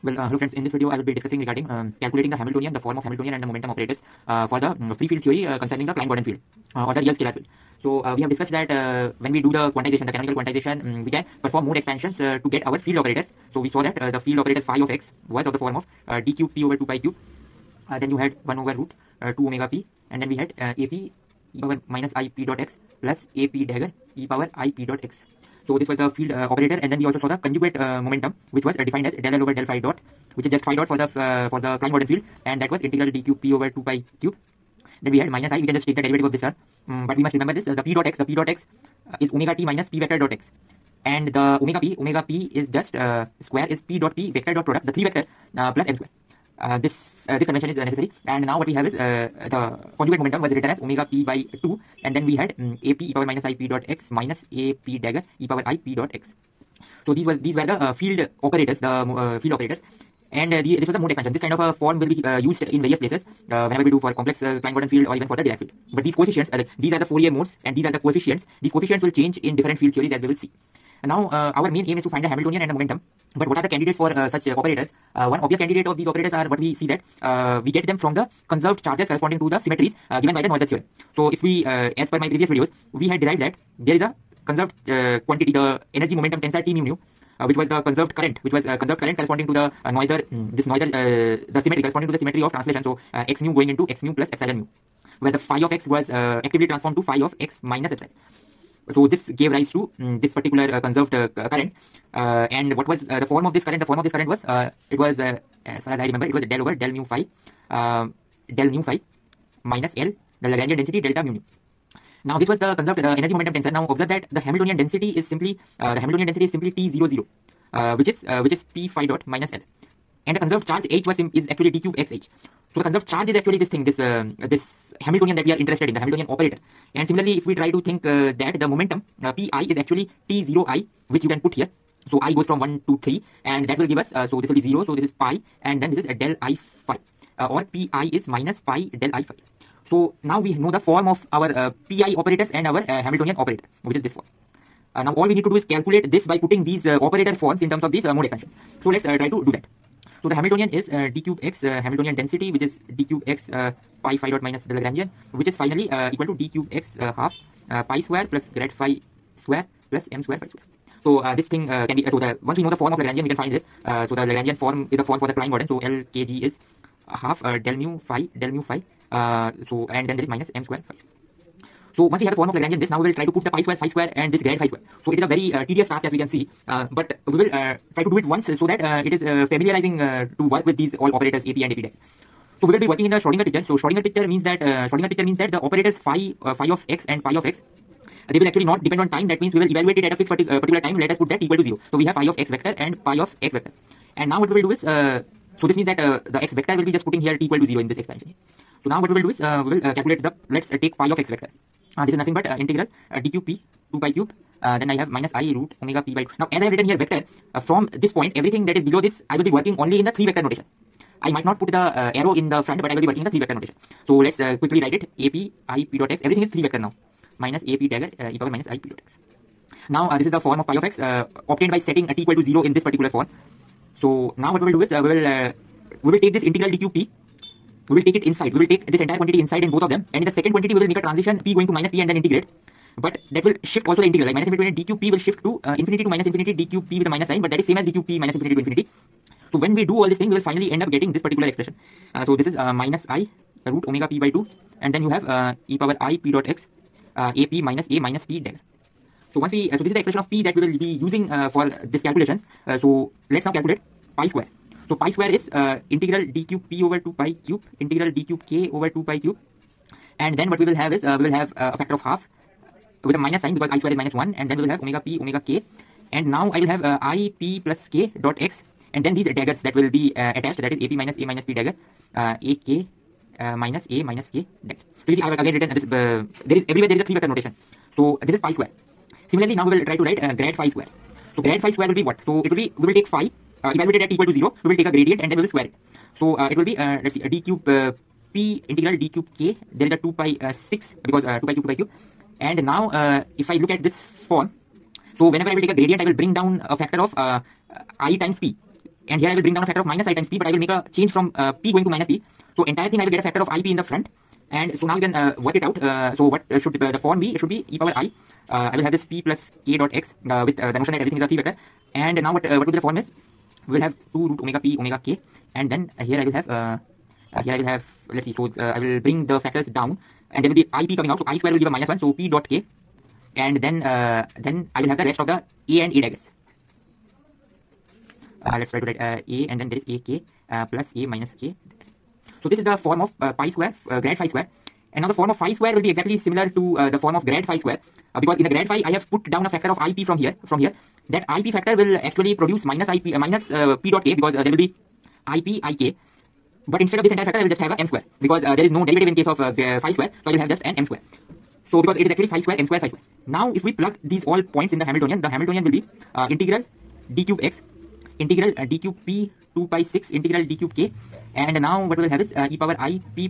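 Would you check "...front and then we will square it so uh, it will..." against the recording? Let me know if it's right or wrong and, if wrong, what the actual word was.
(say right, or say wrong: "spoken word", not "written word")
wrong: "gradient", not "front".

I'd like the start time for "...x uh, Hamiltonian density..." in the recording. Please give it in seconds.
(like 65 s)
151 s.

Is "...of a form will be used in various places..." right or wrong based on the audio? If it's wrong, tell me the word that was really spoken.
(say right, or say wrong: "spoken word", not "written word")
right.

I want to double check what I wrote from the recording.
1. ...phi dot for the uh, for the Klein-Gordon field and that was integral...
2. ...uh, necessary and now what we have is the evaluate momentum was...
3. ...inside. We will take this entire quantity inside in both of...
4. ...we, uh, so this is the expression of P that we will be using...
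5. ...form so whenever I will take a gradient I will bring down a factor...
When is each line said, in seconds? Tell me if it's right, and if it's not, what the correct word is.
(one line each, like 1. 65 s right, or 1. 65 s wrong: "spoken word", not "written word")
1. 30 s right
2. 47 s wrong: "conjugate", not "evaluate"
3. 228 s right
4. 249 s right
5. 294 s right.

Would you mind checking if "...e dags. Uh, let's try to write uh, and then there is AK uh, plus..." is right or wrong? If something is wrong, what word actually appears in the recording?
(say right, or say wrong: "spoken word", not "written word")
right.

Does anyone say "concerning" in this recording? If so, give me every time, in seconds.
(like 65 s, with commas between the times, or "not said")
5 s.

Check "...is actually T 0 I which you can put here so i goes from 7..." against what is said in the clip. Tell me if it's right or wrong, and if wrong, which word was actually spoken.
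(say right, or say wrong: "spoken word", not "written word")
wrong: "1", not "7".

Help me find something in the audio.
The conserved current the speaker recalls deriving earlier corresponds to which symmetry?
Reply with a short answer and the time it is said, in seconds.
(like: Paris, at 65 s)
Translation, at 92 s.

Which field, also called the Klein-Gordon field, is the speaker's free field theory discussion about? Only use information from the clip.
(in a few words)
Real scalar field.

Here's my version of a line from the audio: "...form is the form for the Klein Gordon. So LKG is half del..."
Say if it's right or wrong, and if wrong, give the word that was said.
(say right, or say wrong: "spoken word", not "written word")
right.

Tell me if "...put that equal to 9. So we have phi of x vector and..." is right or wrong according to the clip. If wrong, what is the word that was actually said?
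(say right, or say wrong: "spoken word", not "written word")
wrong: "0", not "9".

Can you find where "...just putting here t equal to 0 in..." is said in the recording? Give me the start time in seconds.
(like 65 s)
196 s.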